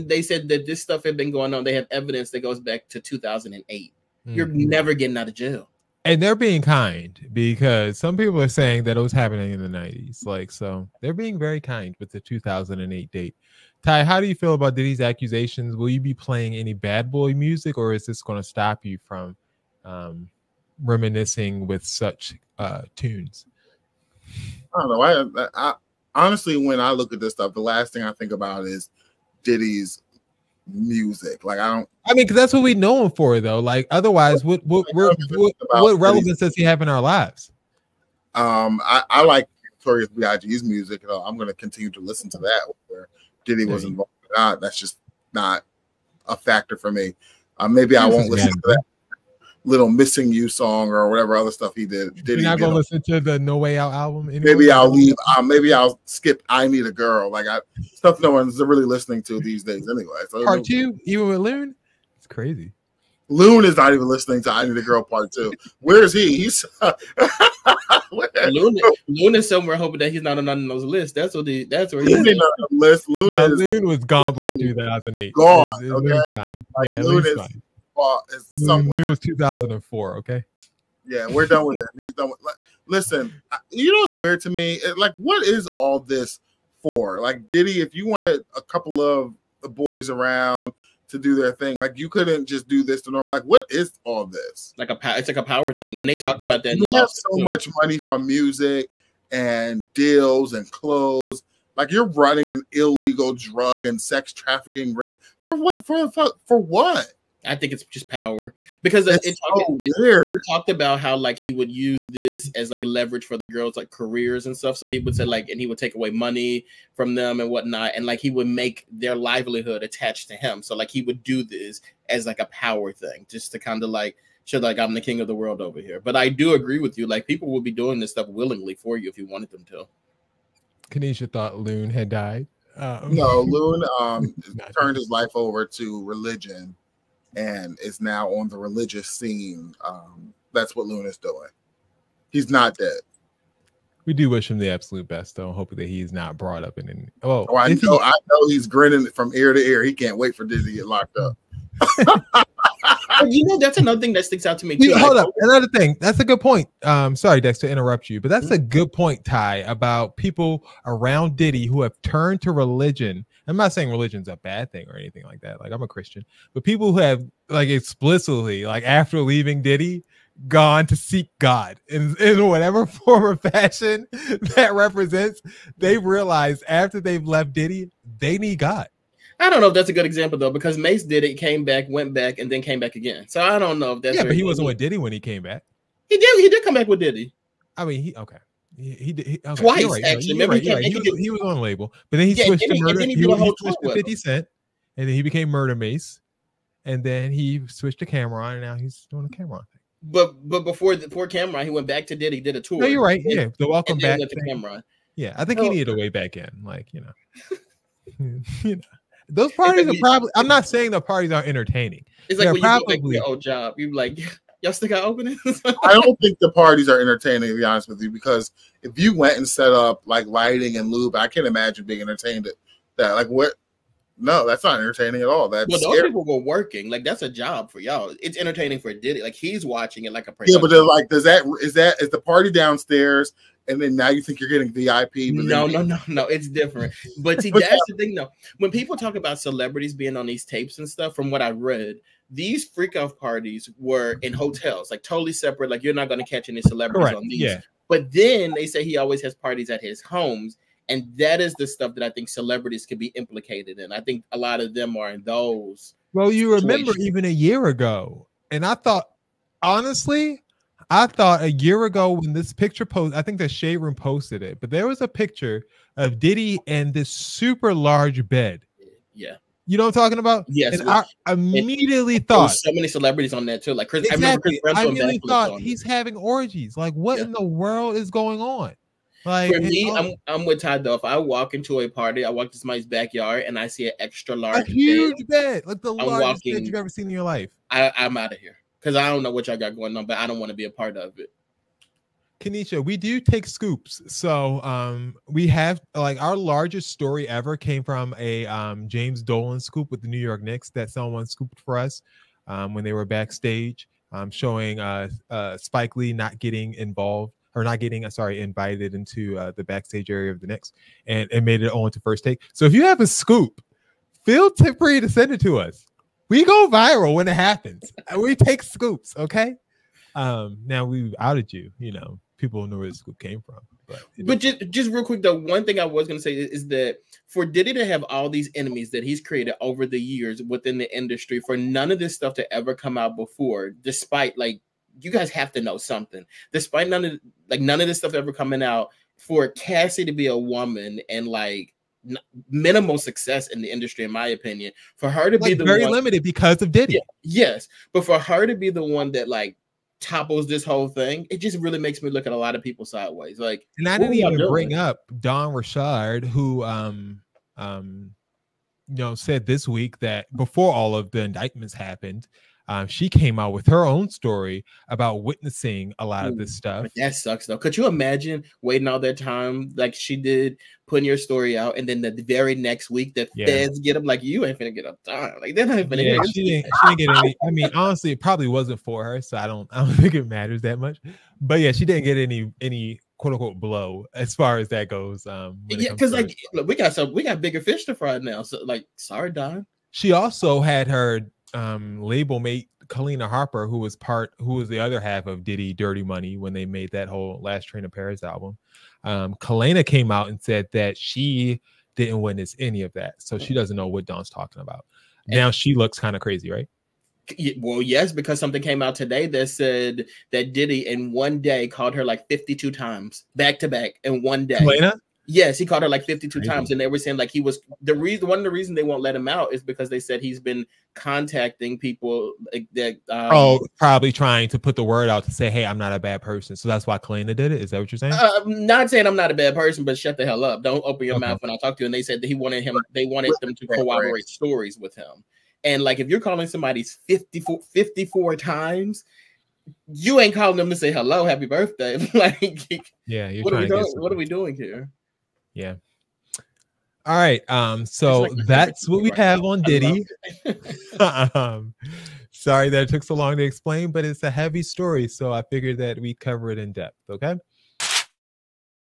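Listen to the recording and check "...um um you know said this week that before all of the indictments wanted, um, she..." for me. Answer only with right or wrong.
wrong.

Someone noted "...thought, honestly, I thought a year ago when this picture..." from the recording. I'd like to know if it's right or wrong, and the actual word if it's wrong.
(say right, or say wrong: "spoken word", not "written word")
right.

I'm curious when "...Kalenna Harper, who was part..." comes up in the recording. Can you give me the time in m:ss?
6:32.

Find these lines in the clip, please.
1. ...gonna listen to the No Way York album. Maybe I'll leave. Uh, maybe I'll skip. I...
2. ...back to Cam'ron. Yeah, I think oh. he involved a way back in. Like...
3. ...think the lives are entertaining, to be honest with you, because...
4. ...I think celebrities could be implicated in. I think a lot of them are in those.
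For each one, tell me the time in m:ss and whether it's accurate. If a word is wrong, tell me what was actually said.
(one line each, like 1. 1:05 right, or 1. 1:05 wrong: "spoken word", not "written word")
1. 0:52 wrong: "Out", not "York"
2. 3:23 wrong: "needed", not "involved"
3. 3:36 wrong: "parties", not "lives"
4. 4:12 right.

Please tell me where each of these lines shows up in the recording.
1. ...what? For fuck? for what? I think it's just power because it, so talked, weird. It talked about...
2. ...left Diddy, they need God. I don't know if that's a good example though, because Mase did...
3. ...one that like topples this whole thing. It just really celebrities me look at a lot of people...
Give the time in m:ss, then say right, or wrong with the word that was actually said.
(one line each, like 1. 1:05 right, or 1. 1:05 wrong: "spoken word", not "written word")
1. 1:45 right
2. 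2:57 right
3. 5:48 wrong: "makes", not "celebrities".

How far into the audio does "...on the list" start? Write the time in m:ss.
1:12.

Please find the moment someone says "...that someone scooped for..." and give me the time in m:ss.
5:00.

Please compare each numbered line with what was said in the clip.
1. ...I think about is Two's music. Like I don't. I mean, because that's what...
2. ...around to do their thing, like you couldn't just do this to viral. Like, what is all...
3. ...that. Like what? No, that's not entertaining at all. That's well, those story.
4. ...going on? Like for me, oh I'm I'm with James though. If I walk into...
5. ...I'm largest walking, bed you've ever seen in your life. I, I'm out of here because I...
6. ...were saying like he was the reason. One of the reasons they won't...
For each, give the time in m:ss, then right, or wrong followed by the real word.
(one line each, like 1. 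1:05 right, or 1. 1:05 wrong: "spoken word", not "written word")
1. 0:28 wrong: "Diddy", not "Two"
2. 1:30 wrong: "normal", not "viral"
3. 3:42 wrong: "scary", not "story"
4. 4:38 wrong: "Todd", not "James"
5. 4:45 right
6. 6:56 right.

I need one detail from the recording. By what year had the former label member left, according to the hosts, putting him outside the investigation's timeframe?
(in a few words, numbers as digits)
2004.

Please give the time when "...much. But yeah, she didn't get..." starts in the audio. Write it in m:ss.
6:20.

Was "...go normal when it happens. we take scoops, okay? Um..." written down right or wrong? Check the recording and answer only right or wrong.
wrong.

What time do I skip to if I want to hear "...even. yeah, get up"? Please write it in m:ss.
6:15.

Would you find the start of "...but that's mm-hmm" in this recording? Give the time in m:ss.
2:38.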